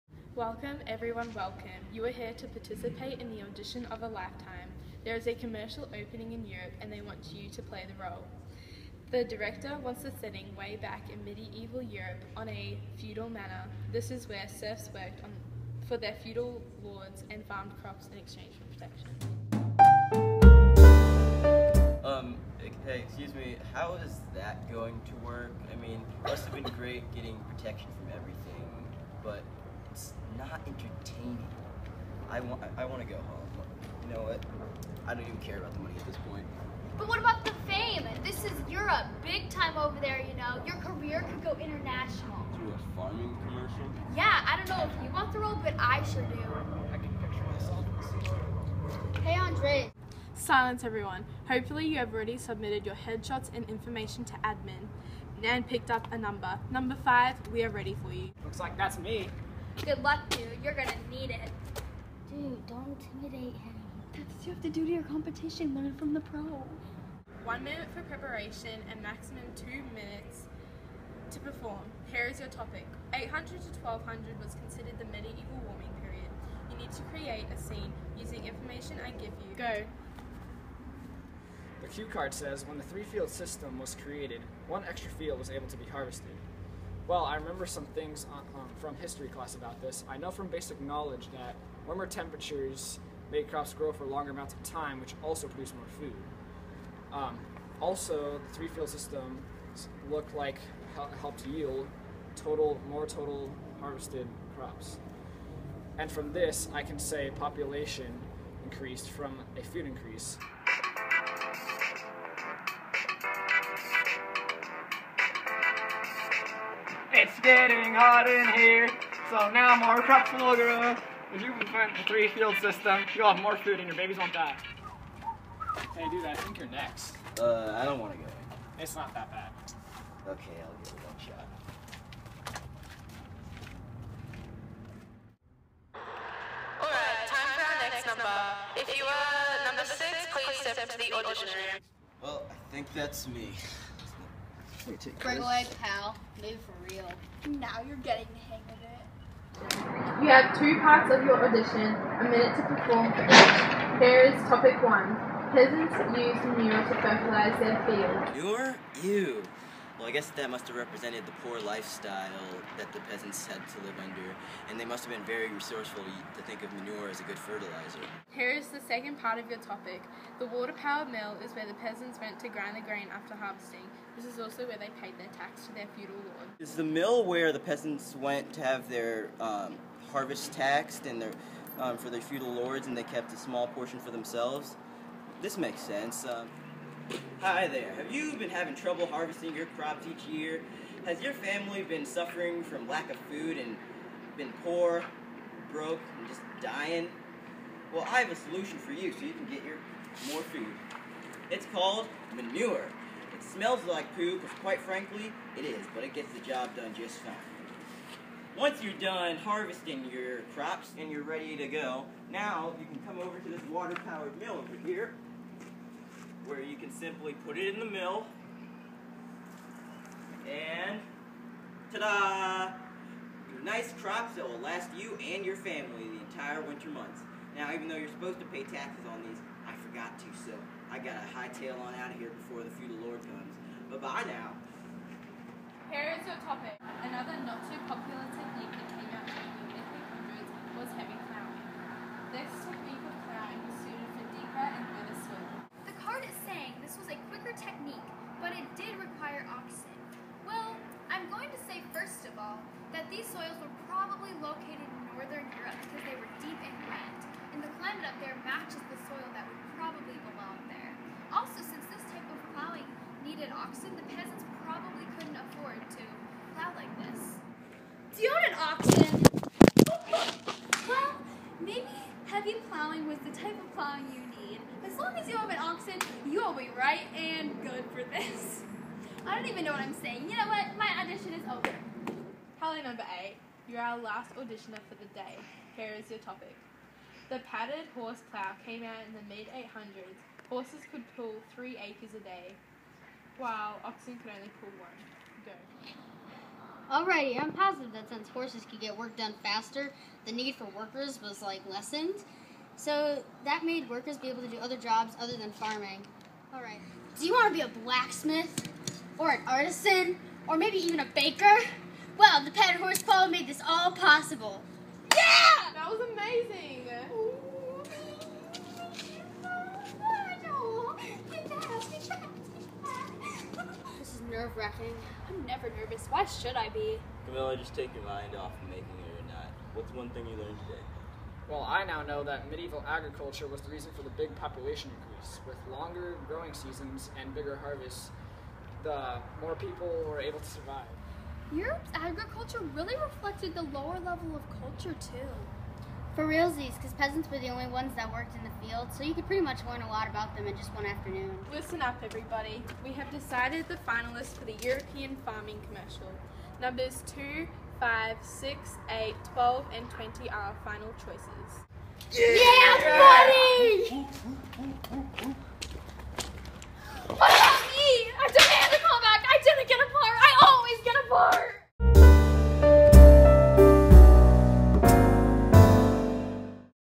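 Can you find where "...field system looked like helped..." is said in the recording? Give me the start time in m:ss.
1:38.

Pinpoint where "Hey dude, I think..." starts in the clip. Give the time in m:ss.
2:05.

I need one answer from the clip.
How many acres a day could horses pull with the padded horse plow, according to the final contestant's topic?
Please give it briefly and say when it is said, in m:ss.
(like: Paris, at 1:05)
3, at 4:51.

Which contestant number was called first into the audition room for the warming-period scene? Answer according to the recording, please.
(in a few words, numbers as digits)
5.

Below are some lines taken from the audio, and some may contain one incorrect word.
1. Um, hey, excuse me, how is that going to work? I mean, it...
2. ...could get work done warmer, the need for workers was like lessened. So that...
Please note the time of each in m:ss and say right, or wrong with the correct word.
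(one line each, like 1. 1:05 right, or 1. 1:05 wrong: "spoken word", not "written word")
1. 0:22 right
2. 4:58 wrong: "faster", not "warmer".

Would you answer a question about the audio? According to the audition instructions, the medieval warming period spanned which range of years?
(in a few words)
800 to 1200.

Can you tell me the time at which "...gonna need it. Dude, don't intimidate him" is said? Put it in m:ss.
1:00.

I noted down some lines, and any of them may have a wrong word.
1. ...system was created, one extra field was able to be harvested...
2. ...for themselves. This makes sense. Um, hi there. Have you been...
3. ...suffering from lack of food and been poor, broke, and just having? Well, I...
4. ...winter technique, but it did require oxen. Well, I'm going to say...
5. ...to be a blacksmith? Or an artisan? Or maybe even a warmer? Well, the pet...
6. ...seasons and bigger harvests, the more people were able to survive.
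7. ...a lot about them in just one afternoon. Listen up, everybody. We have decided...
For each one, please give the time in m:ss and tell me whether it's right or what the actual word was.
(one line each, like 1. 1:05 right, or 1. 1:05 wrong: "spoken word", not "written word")
1. 1:23 right
2. 3:03 right
3. 3:12 wrong: "dying", not "having"
4. 4:07 wrong: "quicker", not "winter"
5. 5:07 wrong: "baker", not "warmer"
6. 5:36 right
7. 5:49 right.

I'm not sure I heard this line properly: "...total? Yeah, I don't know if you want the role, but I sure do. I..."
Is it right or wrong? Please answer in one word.
wrong.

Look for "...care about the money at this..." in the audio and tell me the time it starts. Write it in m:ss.
0:35.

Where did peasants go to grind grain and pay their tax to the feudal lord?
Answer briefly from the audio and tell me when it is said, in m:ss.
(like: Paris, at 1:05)
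The water powered mill, at 2:50.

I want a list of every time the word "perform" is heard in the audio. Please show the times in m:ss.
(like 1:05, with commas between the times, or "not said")
1:11, 2:32.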